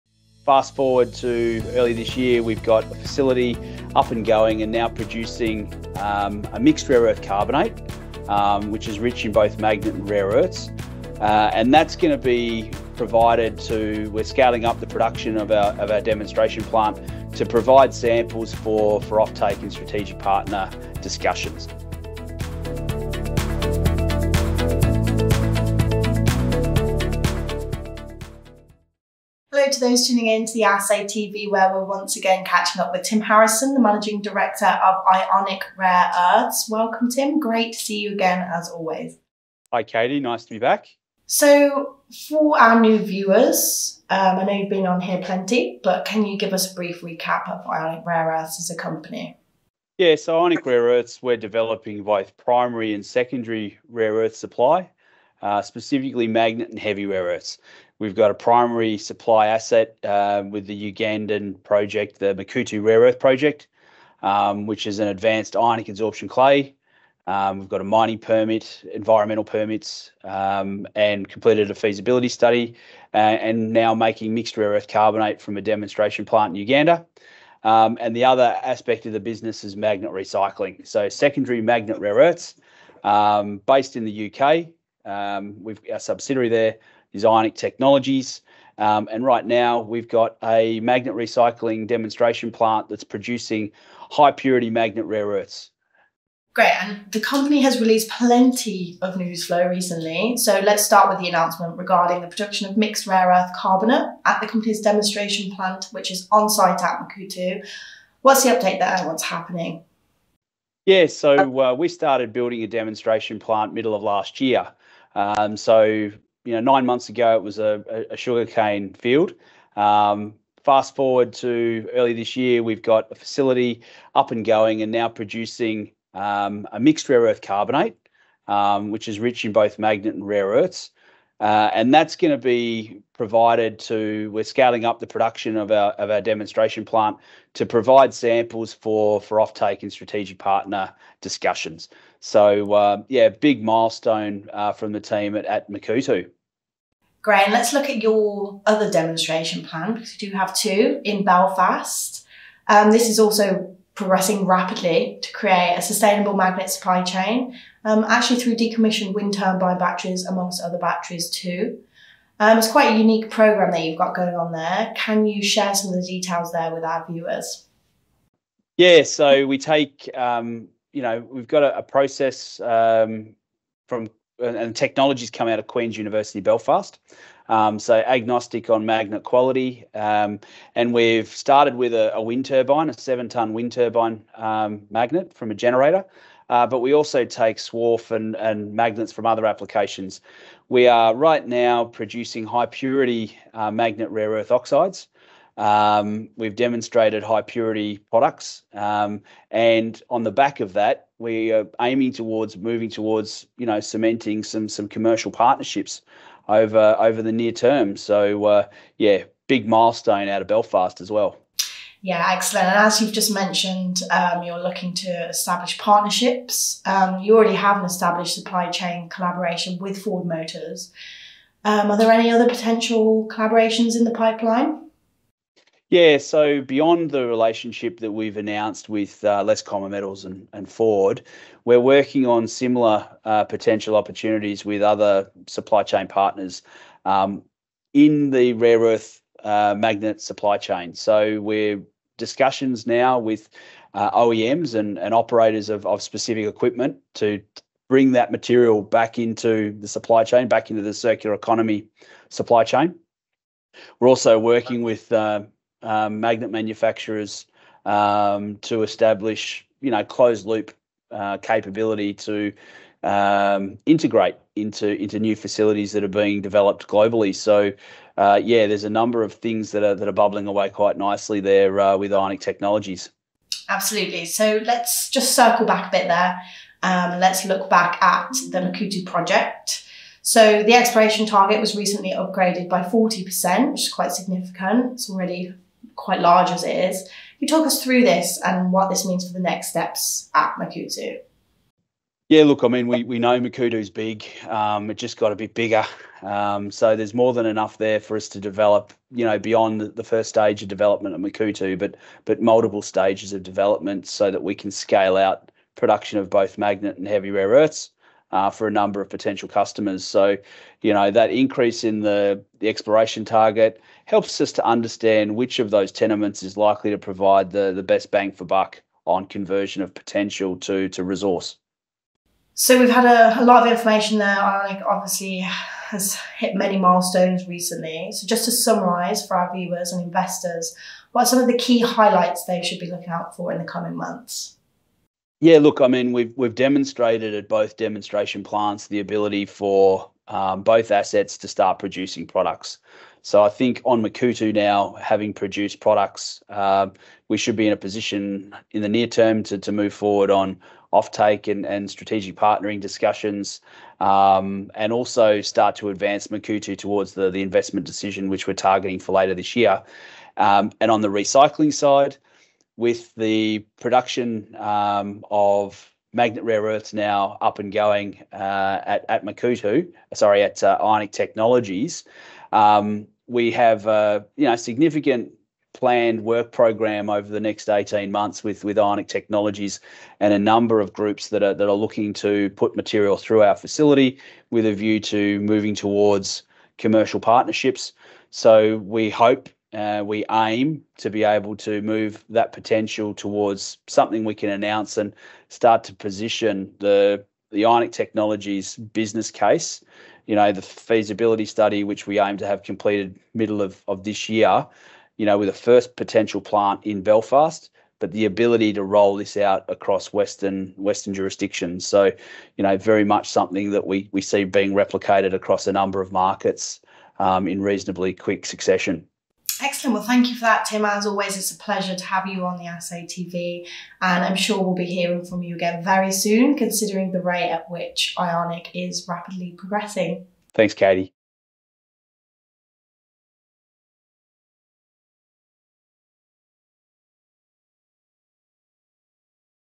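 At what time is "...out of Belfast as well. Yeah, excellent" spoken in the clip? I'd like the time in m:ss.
3:30.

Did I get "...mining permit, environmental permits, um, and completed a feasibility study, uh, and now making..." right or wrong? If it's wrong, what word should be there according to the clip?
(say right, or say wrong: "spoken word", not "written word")
right.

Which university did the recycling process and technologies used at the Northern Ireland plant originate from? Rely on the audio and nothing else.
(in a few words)
Queen's University Belfast.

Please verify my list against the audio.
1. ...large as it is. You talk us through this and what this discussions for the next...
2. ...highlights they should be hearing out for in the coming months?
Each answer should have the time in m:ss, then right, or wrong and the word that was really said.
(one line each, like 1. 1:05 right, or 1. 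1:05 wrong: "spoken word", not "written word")
1. 4:46 wrong: "means", not "discussions"
2. 5:31 wrong: "looking", not "hearing".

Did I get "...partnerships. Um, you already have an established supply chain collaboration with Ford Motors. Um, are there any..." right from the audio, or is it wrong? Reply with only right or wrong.
right.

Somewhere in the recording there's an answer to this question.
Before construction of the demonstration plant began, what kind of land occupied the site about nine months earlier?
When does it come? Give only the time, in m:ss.
1:58.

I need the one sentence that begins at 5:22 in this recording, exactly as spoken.
So we've had a lot of information there.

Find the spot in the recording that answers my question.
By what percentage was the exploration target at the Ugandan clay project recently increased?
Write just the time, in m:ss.
4:42.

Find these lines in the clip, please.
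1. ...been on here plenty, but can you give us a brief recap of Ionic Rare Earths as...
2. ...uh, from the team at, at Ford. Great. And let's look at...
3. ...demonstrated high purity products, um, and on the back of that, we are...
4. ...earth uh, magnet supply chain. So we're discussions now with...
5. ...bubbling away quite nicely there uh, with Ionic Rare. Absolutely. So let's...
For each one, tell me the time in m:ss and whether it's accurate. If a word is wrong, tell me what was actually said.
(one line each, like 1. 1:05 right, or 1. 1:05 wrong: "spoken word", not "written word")
1. 0:44 right
2. 2:24 wrong: "Makuutu", not "Ford"
3. 3:16 right
4. 3:58 right
5. 4:30 wrong: "Technologies", not "Rare".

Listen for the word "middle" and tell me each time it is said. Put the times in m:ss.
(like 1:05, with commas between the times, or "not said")
1:53, 6:43.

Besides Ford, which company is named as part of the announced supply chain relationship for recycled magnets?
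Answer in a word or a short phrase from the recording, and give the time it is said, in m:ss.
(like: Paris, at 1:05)
Common Metals, at 3:49.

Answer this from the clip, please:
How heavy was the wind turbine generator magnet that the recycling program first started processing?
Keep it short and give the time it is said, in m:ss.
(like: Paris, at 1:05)
7 tons, at 3:02.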